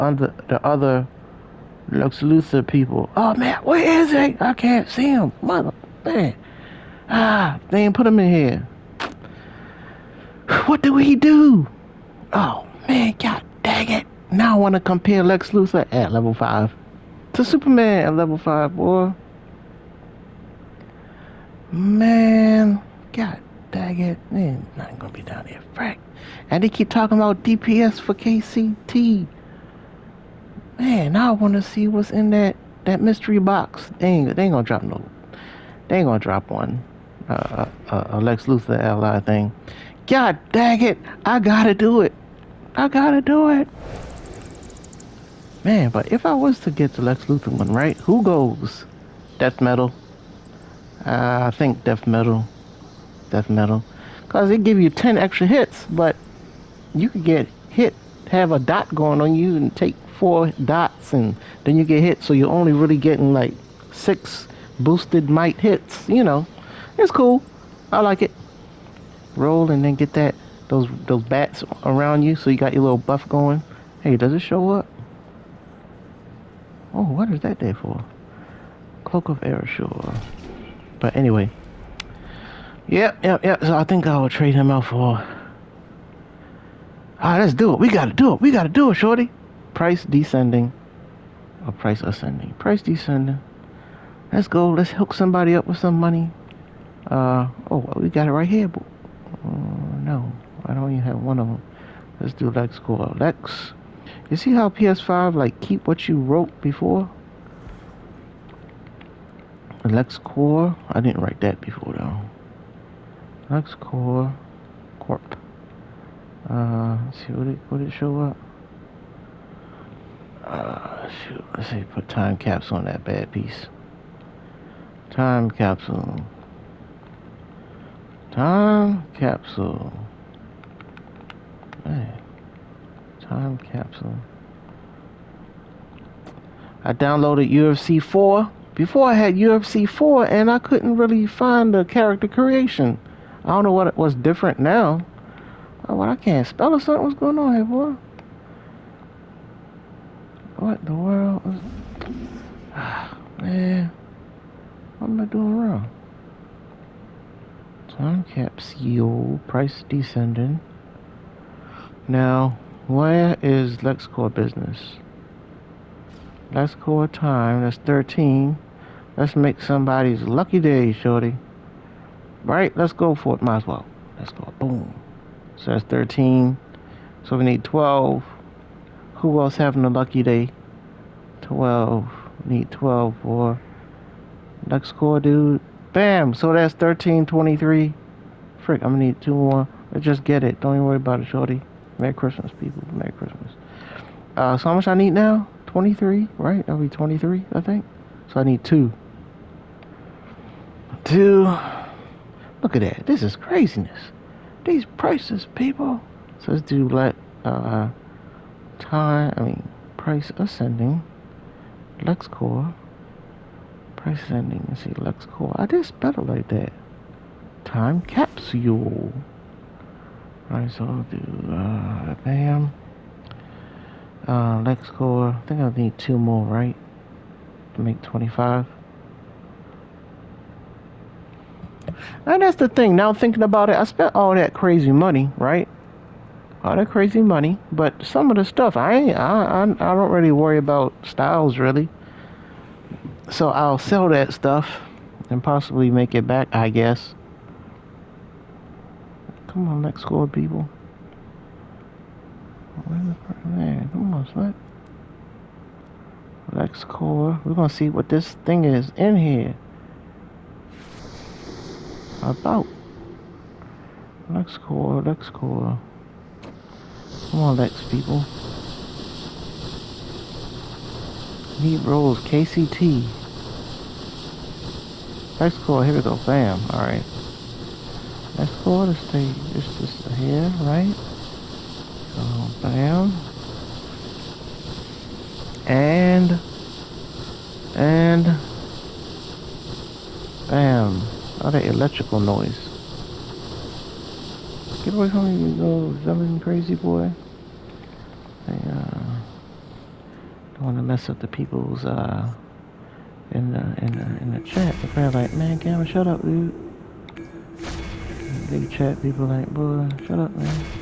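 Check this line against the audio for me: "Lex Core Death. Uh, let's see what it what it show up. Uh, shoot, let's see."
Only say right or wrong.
wrong.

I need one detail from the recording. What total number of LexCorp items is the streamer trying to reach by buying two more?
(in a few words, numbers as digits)
25.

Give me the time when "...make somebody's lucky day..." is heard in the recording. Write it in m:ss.
2:49.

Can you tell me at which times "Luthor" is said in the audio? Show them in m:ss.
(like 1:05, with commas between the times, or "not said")
0:02, 0:15, 0:38, 0:47.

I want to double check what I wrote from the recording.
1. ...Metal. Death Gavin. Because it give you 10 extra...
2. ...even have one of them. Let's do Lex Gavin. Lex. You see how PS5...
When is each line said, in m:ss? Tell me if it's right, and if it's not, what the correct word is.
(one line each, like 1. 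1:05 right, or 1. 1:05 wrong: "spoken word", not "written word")
1. 0:52 wrong: "Metal", not "Gavin"
2. 1:40 wrong: "Core", not "Gavin".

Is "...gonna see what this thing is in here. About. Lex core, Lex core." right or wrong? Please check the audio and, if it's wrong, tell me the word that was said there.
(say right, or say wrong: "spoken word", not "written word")
right.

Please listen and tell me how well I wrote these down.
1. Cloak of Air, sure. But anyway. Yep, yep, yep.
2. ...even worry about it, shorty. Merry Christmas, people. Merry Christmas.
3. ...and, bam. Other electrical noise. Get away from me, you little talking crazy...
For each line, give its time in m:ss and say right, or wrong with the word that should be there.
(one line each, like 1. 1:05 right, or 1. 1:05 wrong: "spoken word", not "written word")
1. 1:19 right
2. 3:10 right
3. 4:47 wrong: "zumming", not "talking".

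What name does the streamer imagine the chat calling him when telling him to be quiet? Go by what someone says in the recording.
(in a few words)
Gavin.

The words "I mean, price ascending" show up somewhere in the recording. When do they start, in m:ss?
3:29.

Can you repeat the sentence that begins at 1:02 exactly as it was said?
So you're only really getting like six boosted might hits.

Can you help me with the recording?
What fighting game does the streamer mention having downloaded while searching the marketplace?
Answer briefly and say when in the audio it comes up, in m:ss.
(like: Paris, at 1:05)
UFC 4, at 2:16.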